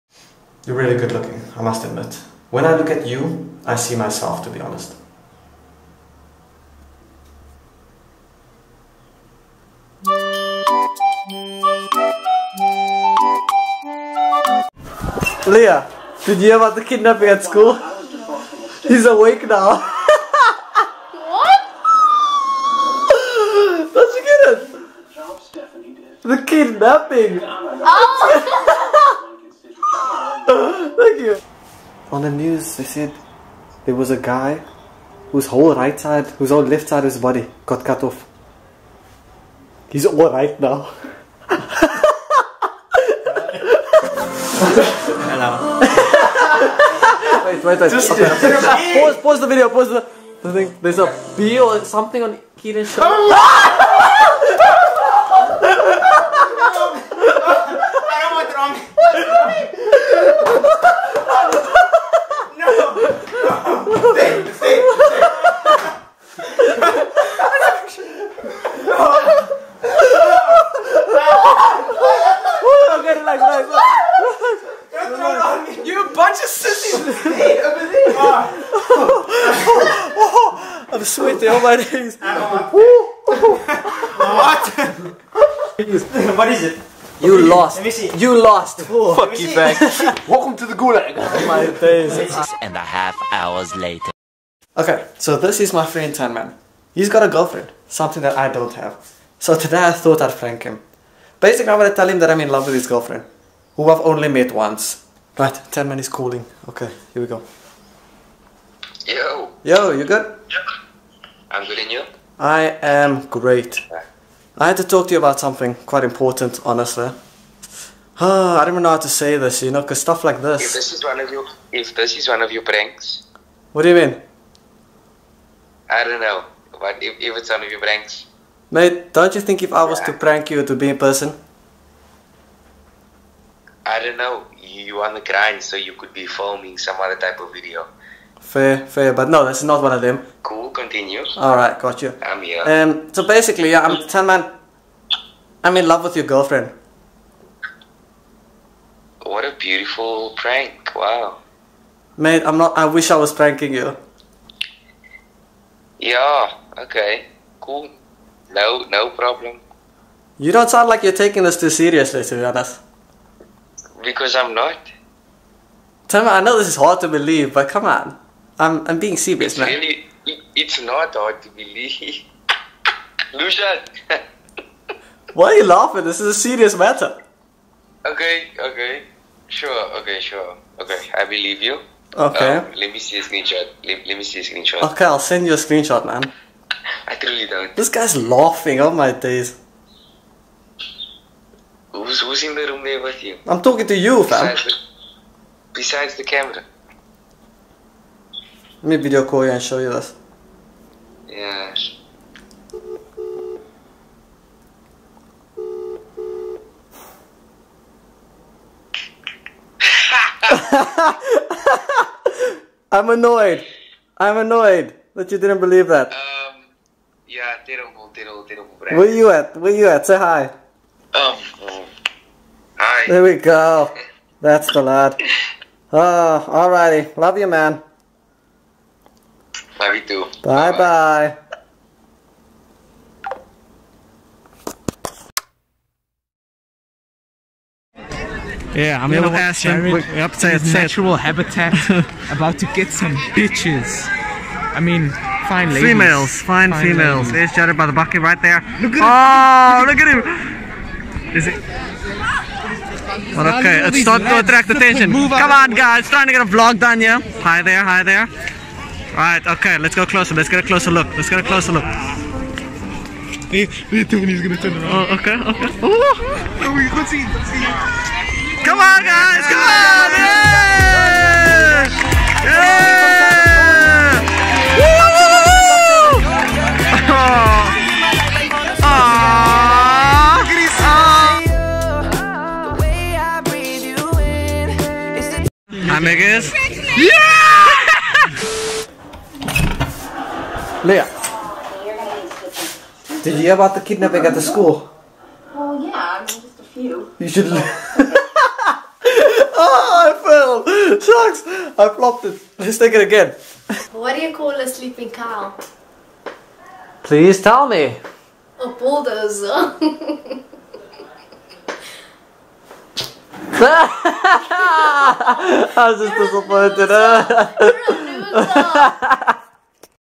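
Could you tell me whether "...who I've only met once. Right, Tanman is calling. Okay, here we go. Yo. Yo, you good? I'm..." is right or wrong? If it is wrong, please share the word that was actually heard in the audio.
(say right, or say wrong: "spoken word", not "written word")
right.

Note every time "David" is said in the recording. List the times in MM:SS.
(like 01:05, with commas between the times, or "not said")
not said.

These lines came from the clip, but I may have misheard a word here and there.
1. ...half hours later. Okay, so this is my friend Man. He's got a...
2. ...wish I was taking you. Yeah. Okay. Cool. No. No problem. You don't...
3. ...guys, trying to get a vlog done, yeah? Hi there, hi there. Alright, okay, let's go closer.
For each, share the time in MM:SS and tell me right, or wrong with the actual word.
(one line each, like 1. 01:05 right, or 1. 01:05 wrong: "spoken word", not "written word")
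1. 01:32 right
2. 02:32 wrong: "pranking", not "taking"
3. 04:15 right.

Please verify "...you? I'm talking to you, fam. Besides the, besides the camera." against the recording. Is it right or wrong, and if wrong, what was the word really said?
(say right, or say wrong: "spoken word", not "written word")
right.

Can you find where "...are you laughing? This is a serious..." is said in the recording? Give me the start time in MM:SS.
02:55.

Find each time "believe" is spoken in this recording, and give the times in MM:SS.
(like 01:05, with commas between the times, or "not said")
02:47, 02:51, 03:01, 03:35.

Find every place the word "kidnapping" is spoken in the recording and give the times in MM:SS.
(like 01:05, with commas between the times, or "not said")
00:16, 00:26, 04:53.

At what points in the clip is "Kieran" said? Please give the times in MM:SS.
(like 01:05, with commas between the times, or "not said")
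00:52.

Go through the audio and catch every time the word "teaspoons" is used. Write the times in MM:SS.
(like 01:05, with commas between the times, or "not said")
not said.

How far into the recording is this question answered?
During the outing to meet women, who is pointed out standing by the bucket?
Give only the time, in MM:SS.
04:07.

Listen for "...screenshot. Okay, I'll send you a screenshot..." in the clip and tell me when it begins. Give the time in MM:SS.
03:04.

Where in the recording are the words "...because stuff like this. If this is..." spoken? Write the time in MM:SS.
01:59.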